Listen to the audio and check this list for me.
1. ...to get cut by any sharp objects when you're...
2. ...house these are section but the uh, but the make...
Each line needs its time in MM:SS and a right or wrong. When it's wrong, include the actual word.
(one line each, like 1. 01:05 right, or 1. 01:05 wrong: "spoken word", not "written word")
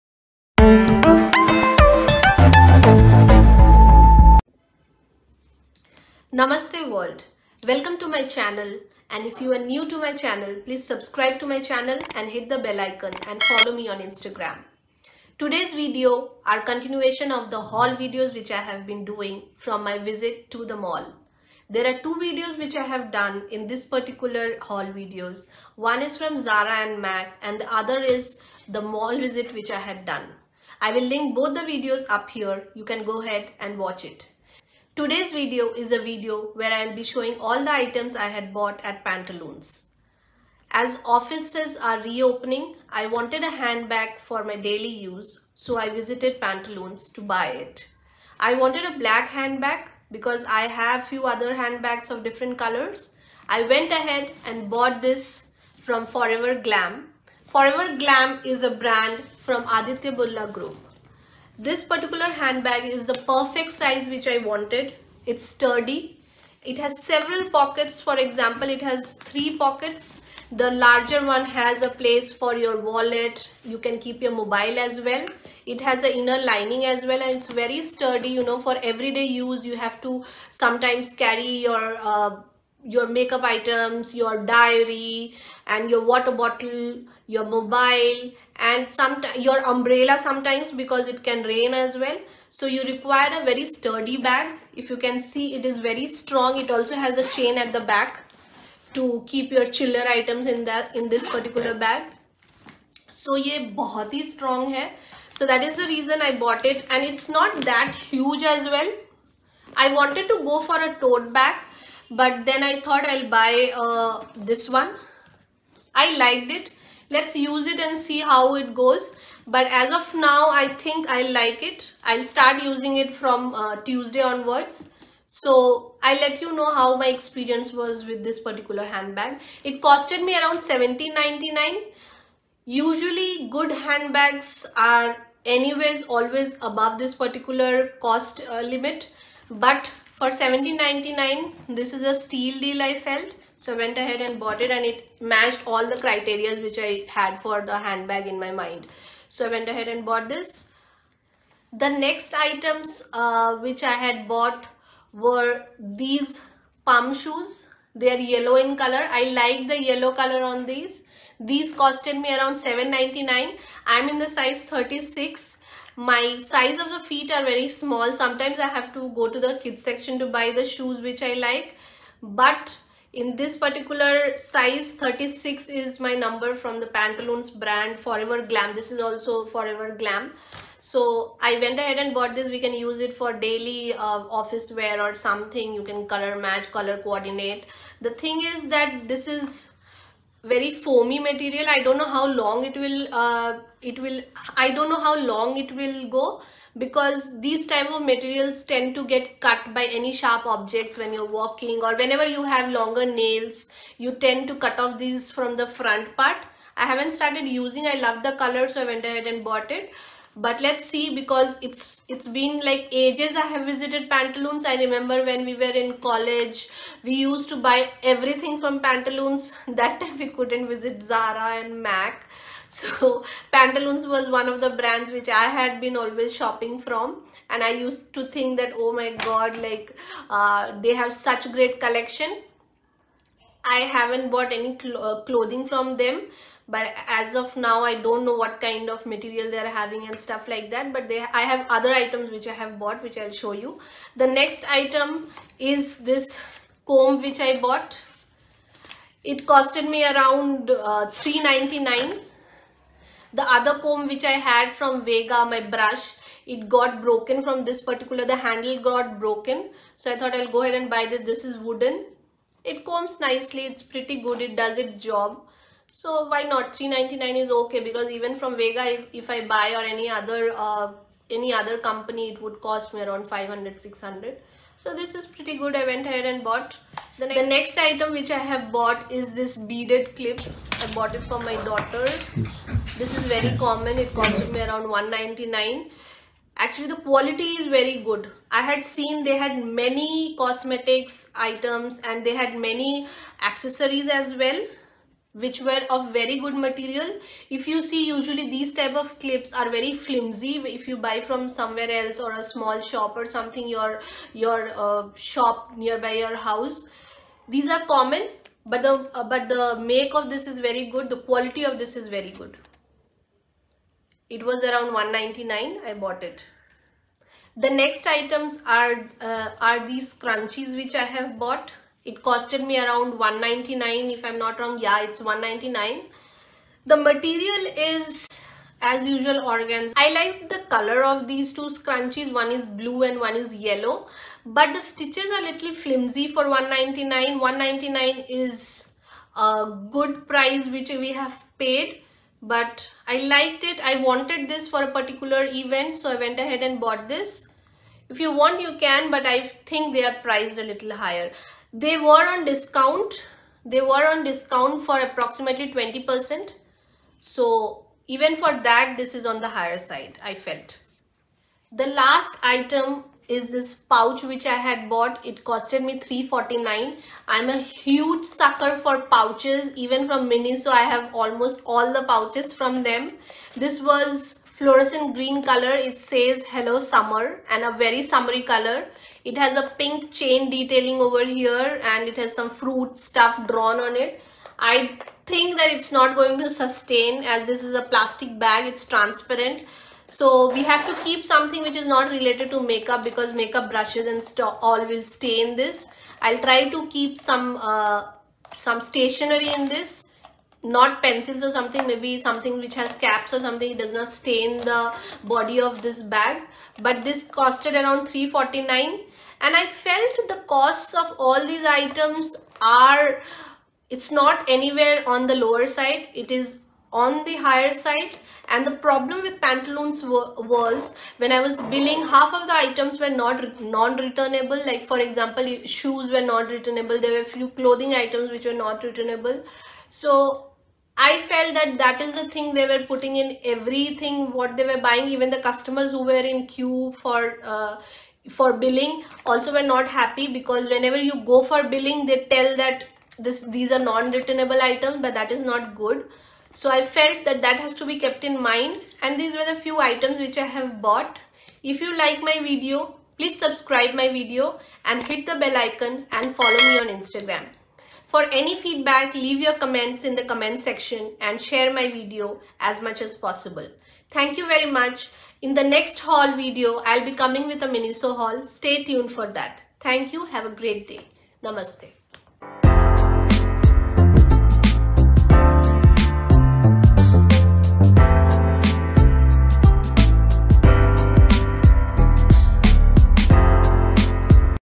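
1. 03:18 right
2. 05:06 wrong: "common", not "section".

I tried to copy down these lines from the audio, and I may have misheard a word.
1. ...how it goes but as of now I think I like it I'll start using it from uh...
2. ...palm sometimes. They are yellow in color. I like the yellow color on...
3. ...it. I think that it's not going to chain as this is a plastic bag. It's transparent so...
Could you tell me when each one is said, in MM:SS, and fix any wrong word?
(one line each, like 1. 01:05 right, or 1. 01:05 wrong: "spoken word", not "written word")
1. 01:58 right
2. 02:36 wrong: "shoes", not "sometimes"
3. 06:23 wrong: "sustain", not "chain".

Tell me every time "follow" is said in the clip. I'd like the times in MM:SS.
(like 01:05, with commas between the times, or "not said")
00:13, 07:36.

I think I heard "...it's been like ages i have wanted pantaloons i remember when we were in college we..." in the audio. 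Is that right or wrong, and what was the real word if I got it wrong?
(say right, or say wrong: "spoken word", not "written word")
wrong: "visited", not "wanted".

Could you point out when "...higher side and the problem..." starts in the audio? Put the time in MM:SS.
06:57.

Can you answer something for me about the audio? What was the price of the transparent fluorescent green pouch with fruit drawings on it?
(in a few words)
349.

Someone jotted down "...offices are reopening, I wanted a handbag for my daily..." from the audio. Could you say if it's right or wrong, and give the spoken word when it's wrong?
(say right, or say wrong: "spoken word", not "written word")
right.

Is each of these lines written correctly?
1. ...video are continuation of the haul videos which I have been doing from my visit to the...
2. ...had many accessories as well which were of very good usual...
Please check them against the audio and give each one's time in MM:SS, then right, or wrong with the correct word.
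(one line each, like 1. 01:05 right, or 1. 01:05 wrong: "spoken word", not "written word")
1. 00:15 right
2. 04:52 wrong: "material", not "usual".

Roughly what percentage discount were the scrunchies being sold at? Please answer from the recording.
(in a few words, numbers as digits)
20%.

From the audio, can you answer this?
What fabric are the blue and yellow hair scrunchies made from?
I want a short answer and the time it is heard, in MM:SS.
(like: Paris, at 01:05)
organza, at 05:29.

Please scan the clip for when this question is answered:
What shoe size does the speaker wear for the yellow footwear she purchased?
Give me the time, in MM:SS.
02:43.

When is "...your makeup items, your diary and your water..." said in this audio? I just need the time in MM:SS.
01:22.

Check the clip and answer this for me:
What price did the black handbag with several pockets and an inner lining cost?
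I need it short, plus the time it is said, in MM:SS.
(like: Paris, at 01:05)
1799, at 02:20.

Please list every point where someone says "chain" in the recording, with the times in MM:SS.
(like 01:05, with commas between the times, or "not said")
01:37, 06:20.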